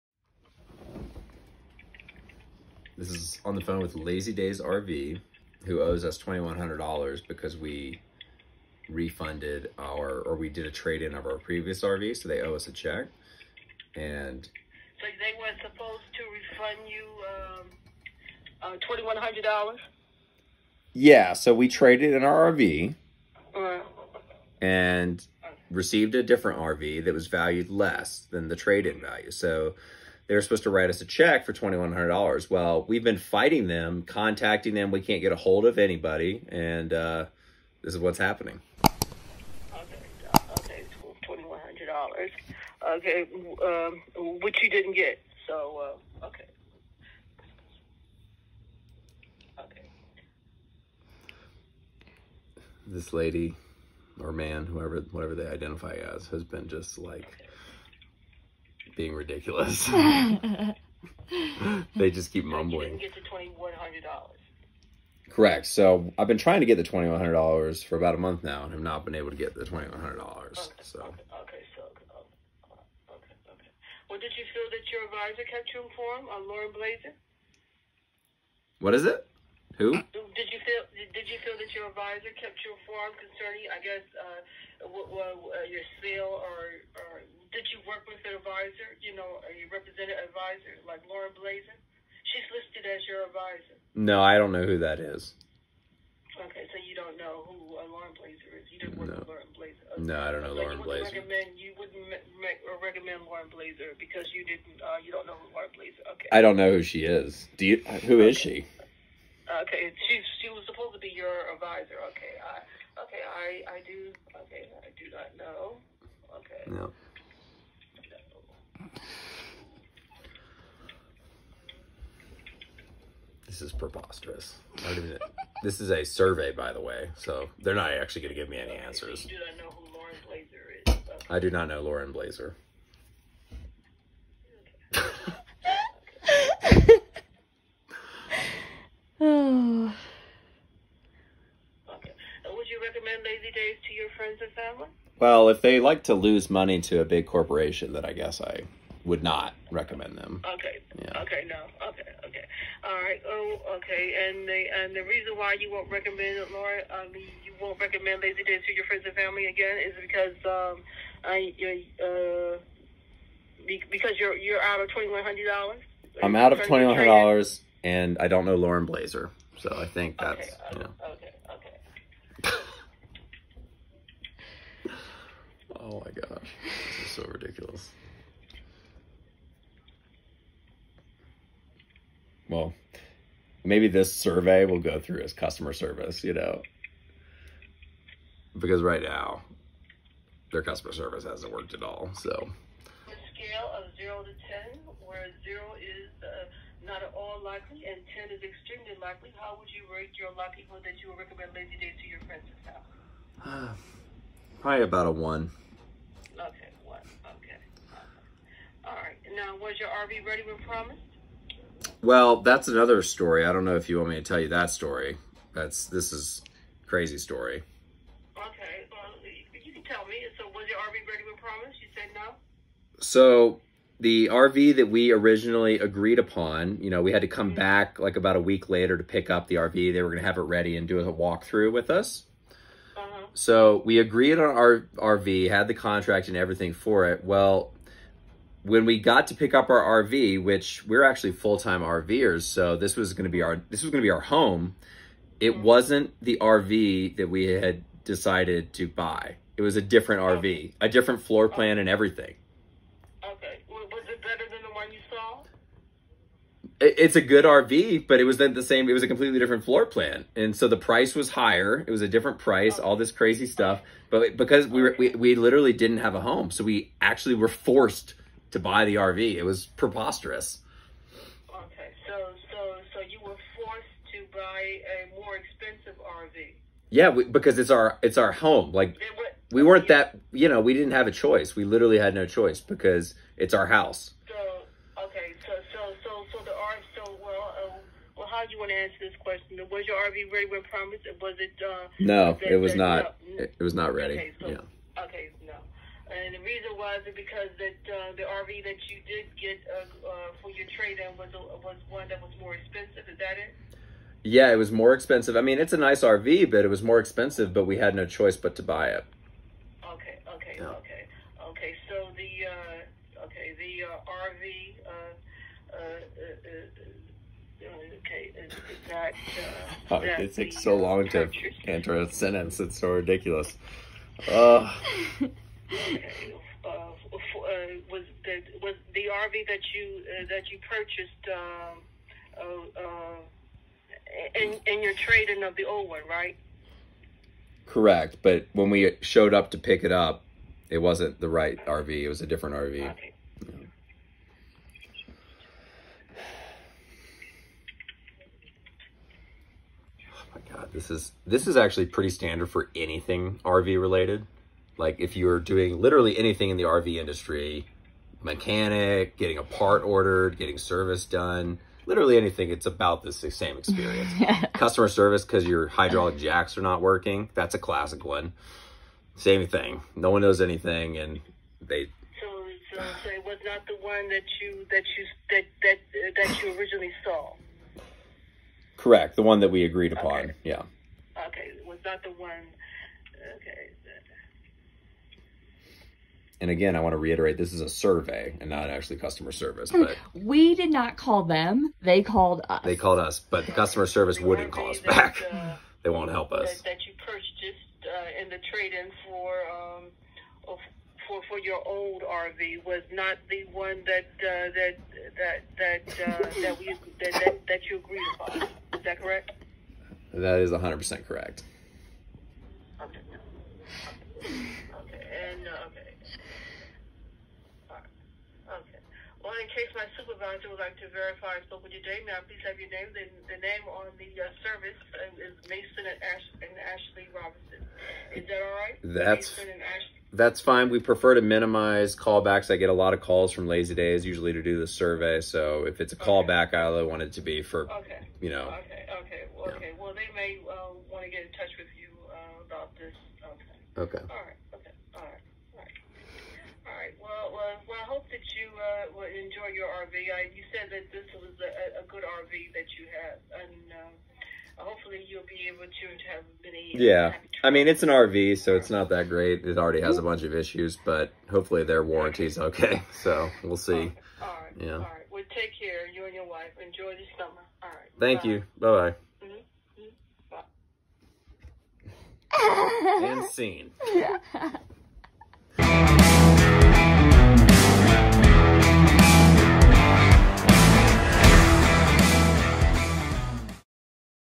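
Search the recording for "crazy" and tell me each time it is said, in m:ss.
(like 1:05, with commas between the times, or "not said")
3:36, 4:23.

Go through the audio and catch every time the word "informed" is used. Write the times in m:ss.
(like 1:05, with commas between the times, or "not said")
1:15, 1:22.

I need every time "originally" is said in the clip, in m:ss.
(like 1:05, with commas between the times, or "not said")
3:45, 6:16.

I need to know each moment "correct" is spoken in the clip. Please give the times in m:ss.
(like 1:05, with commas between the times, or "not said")
1:05, 5:37, 6:18, 6:51.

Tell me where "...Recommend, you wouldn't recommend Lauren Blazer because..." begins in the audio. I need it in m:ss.
1:41.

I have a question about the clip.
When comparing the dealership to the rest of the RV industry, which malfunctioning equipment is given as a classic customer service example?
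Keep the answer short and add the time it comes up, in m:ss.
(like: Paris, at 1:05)
Hydraulic jacks, at 6:05.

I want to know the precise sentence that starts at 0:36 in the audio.
And uh, this is what's happening.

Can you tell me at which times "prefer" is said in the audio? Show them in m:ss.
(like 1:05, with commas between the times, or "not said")
7:10.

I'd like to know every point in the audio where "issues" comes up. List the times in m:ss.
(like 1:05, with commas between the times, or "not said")
7:40.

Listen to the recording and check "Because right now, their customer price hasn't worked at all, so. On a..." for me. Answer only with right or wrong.
wrong.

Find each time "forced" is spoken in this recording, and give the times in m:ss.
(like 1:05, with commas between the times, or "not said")
4:27, 4:33.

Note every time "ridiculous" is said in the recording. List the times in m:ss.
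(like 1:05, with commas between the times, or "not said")
0:59, 2:57, 5:22.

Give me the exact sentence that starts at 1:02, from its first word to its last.
Get to twenty one hundred dollars.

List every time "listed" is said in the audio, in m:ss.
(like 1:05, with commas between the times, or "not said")
1:32.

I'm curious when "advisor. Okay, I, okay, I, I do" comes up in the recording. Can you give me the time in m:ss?
1:51.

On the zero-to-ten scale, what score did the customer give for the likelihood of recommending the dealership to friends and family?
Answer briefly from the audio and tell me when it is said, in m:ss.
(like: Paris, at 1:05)
1, at 3:25.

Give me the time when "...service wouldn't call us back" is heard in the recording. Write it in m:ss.
6:33.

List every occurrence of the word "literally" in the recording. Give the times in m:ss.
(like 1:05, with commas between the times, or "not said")
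4:25, 4:41, 5:55, 6:01.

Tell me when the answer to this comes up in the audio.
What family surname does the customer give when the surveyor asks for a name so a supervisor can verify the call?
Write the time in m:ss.
7:07.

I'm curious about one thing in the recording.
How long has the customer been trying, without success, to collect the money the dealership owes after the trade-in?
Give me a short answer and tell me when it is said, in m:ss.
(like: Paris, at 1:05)
About a month, at 1:07.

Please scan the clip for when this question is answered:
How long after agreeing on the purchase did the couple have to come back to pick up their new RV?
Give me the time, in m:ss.
3:48.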